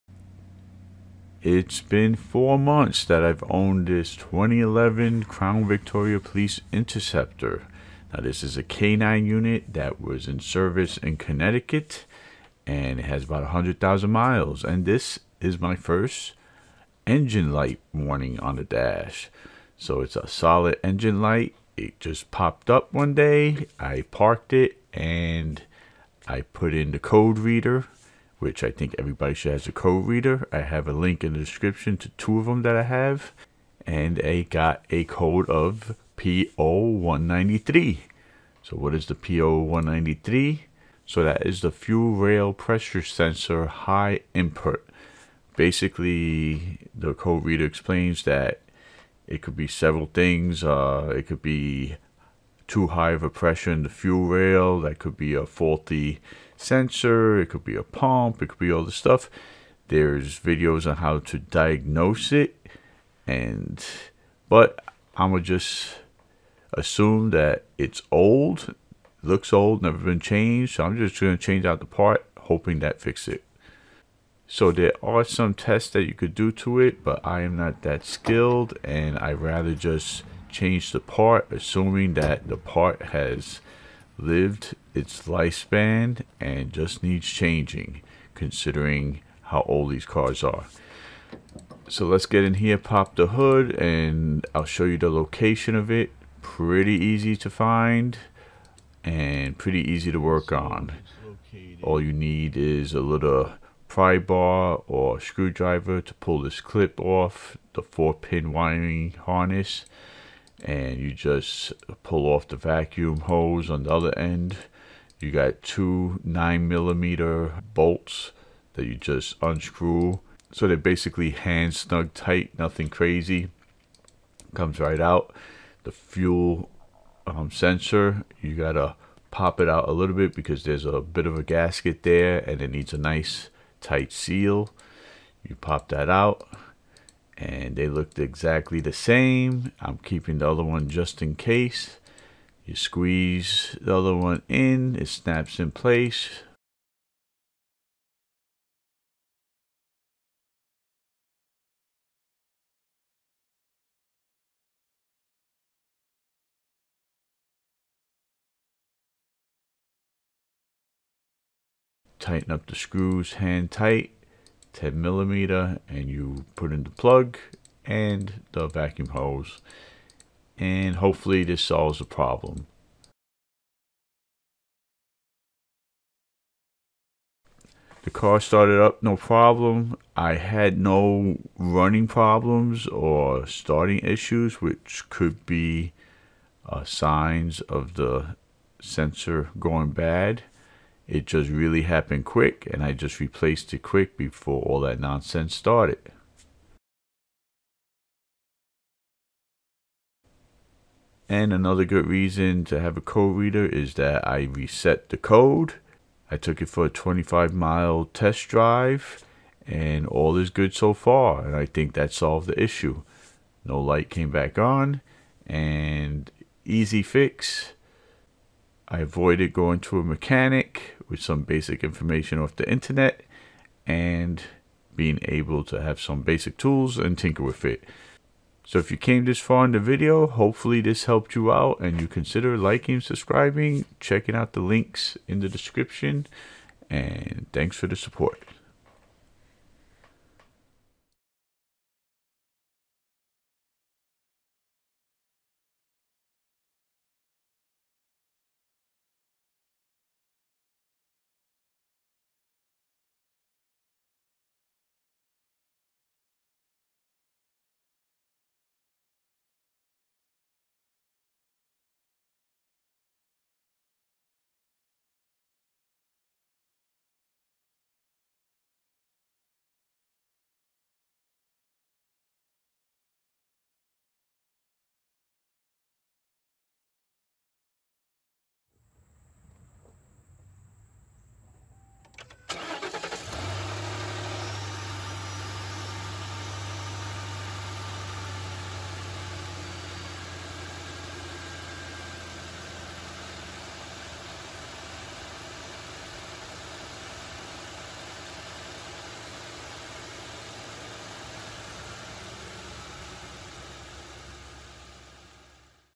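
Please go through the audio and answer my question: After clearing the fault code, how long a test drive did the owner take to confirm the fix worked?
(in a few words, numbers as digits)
25 miles.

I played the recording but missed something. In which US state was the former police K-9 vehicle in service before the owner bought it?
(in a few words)
Connecticut.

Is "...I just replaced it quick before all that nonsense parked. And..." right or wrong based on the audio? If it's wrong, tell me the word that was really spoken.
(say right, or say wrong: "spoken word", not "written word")
wrong: "started", not "parked".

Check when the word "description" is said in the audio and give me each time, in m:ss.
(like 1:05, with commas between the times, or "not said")
0:31, 3:55.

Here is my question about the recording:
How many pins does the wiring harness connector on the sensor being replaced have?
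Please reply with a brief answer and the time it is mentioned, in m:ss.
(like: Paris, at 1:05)
4, at 1:47.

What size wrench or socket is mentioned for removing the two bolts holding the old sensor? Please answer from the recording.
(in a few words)
9 millimeter.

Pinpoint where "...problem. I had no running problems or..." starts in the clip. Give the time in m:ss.
2:59.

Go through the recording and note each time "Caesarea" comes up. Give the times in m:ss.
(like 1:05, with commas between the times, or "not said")
not said.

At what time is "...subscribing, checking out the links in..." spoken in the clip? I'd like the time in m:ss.
3:52.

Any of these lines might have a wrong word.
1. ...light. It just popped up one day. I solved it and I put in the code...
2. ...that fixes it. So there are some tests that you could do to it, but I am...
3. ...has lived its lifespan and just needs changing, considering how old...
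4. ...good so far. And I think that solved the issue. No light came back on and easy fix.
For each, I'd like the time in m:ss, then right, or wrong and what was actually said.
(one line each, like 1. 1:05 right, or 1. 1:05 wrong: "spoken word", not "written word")
1. 0:21 wrong: "parked", not "solved"
2. 1:12 right
3. 1:23 right
4. 3:30 right.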